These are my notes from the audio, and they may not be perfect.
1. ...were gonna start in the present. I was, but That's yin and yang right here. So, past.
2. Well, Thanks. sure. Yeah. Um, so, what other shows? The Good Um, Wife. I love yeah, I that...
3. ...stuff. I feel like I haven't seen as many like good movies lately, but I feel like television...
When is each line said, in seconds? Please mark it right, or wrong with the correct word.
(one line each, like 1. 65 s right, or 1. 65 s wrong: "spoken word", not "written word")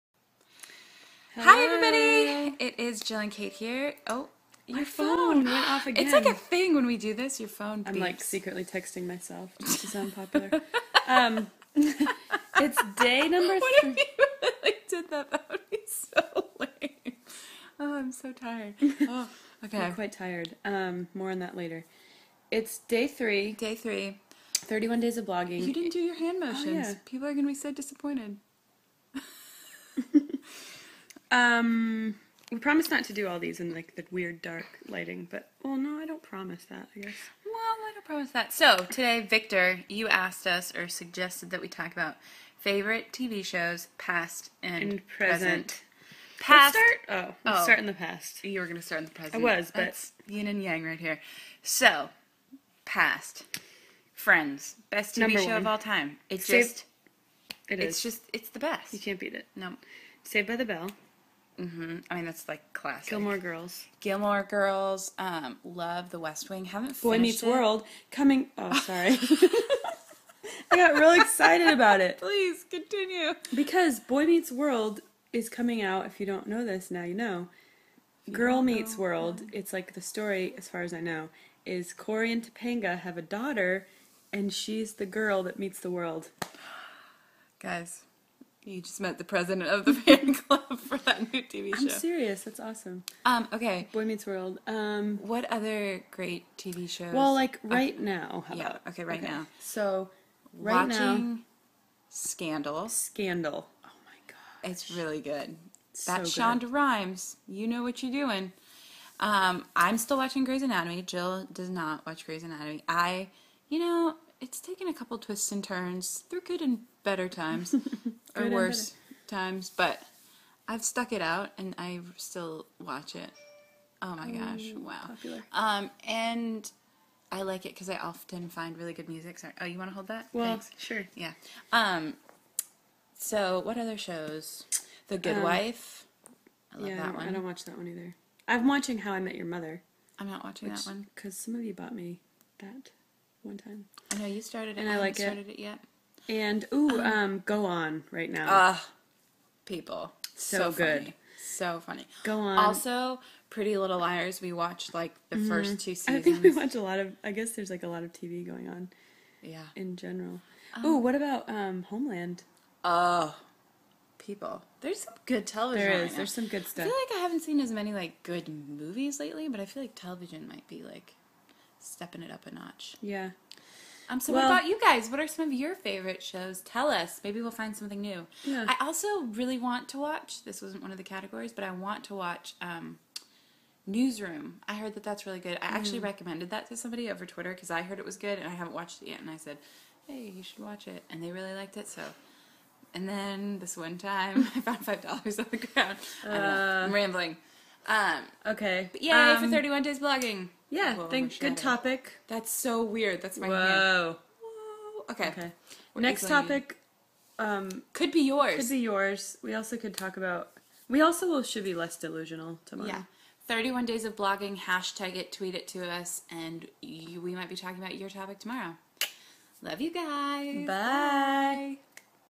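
1. 48 s right
2. 130 s right
3. 166 s right.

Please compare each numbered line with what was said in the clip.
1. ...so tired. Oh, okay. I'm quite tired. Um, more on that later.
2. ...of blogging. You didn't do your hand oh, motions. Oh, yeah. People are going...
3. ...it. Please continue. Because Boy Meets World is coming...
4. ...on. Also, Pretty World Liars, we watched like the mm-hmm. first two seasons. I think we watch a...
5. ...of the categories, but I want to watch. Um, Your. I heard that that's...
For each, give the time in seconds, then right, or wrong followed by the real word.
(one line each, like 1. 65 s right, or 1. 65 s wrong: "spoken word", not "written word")
1. 18 s right
2. 25 s right
3. 72 s right
4. 152 s wrong: "Little", not "World"
5. 180 s wrong: "Newsroom", not "Your".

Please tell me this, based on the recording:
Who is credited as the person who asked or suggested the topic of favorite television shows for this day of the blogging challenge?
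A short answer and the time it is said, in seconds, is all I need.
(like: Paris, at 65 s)
Victor, at 39 s.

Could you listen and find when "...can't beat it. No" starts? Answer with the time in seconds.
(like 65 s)
58 s.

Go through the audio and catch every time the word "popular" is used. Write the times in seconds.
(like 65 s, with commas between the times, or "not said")
10 s, 125 s.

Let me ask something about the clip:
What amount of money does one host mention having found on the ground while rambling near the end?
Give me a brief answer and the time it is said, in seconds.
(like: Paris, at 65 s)
$5, at 194 s.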